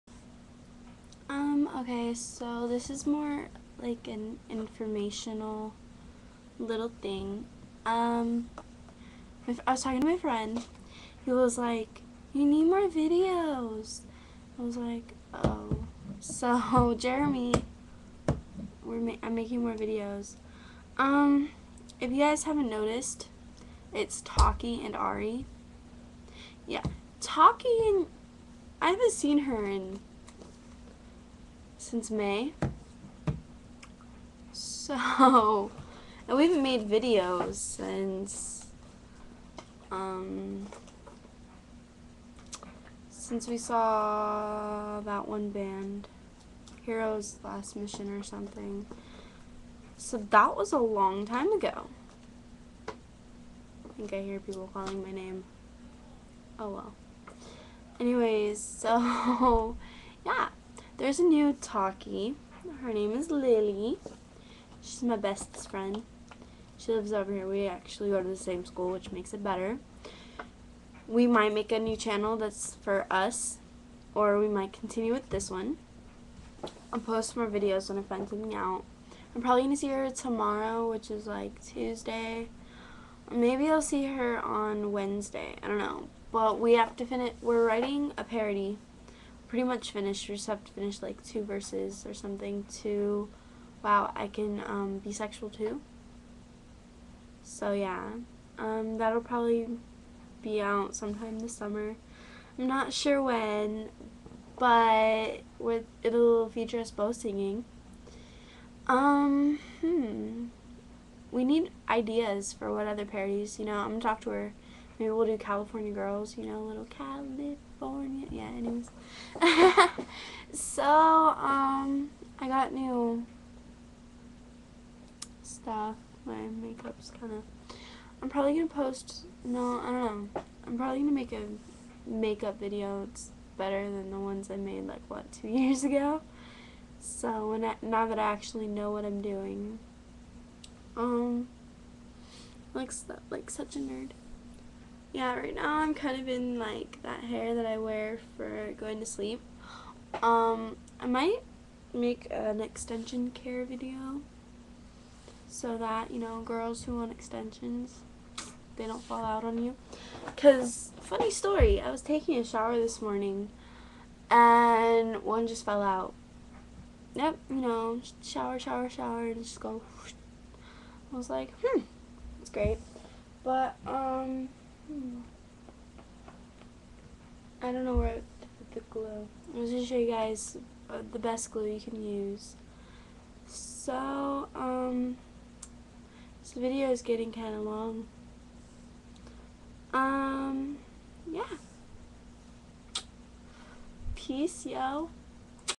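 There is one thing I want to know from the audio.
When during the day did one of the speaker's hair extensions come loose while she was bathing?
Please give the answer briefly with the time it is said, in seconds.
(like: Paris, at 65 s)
This morning, at 162 s.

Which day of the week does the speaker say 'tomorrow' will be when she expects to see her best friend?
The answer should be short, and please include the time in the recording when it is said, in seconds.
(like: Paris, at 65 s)
Tuesday, at 81 s.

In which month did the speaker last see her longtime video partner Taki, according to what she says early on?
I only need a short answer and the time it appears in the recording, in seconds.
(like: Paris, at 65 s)
May, at 32 s.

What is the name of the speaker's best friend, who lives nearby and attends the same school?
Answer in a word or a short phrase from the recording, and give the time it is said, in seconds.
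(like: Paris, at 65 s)
Lily, at 63 s.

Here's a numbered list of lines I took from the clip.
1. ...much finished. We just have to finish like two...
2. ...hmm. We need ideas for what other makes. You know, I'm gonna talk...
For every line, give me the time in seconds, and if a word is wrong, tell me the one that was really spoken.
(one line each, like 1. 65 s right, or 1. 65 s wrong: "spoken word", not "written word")
1. 89 s right
2. 109 s wrong: "parodies", not "makes".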